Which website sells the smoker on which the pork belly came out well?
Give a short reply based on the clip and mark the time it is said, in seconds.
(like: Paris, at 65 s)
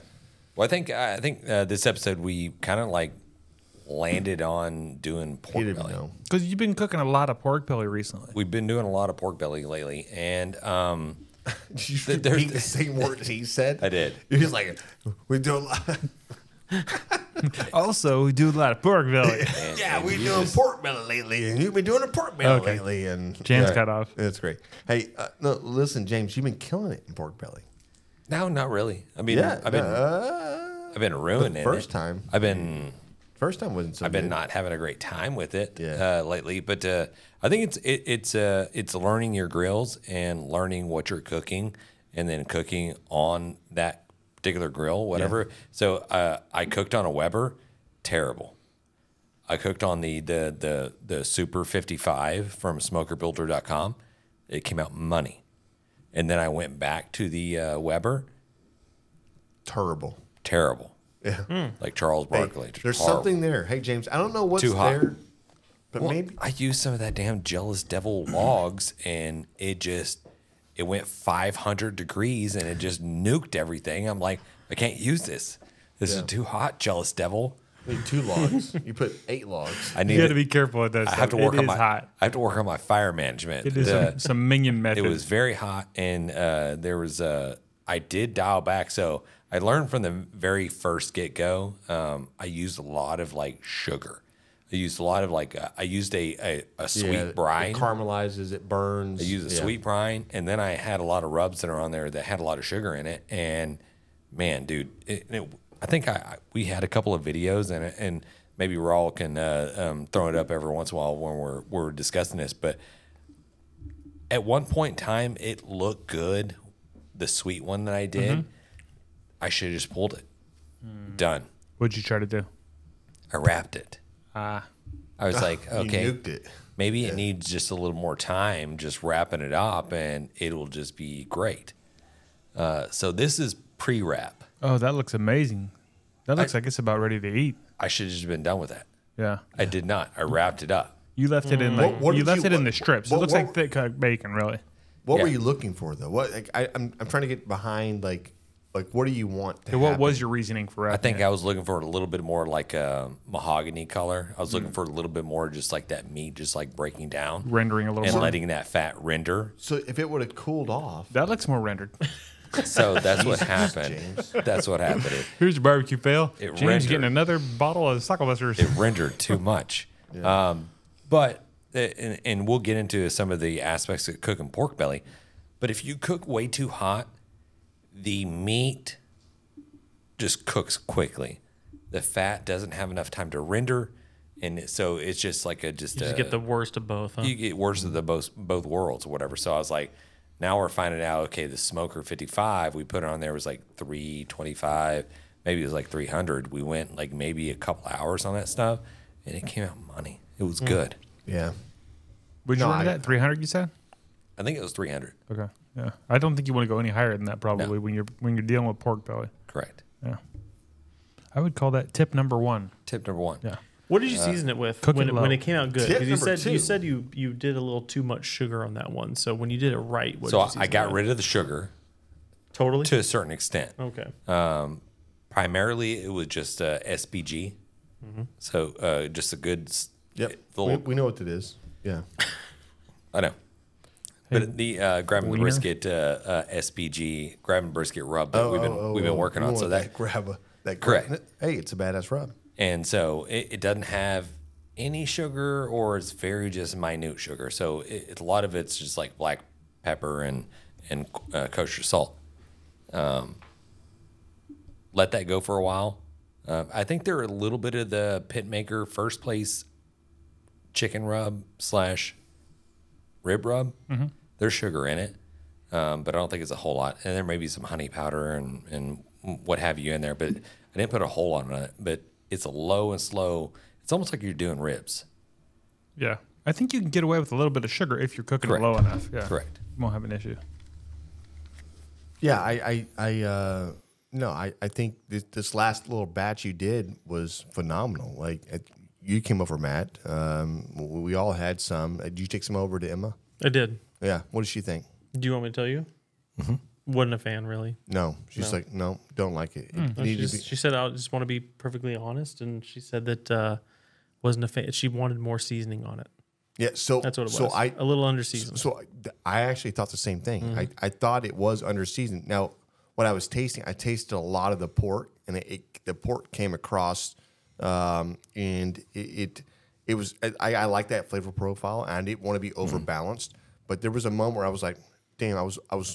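SmokerBuilder.com, at 52 s.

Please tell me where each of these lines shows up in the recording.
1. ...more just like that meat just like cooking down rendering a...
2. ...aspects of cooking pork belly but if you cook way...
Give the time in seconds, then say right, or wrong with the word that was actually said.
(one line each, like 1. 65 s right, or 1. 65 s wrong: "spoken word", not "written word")
1. 155 s wrong: "breaking", not "cooking"
2. 173 s right.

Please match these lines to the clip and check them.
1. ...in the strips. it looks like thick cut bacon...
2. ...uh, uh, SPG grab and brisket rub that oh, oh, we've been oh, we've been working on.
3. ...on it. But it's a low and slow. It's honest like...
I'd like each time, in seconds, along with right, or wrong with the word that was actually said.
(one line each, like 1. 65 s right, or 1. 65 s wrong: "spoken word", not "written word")
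1. 142 s right
2. 235 s right
3. 271 s wrong: "almost", not "honest".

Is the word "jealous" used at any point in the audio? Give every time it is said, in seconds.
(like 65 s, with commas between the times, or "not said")
67 s, 76 s.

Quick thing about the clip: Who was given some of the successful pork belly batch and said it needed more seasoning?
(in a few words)
Emma.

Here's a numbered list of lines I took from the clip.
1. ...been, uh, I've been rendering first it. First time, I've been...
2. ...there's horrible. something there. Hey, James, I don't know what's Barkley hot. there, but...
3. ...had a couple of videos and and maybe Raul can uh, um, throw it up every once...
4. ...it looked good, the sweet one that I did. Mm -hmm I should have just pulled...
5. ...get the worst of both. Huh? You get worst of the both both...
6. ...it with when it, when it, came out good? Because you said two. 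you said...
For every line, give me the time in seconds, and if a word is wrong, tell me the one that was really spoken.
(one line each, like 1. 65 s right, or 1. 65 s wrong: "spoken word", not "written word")
1. 29 s wrong: "ruining", not "rendering"
2. 62 s wrong: "Too", not "Barkley"
3. 106 s right
4. 115 s right
5. 186 s right
6. 214 s right.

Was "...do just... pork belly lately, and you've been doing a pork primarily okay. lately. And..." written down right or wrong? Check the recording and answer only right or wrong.
wrong.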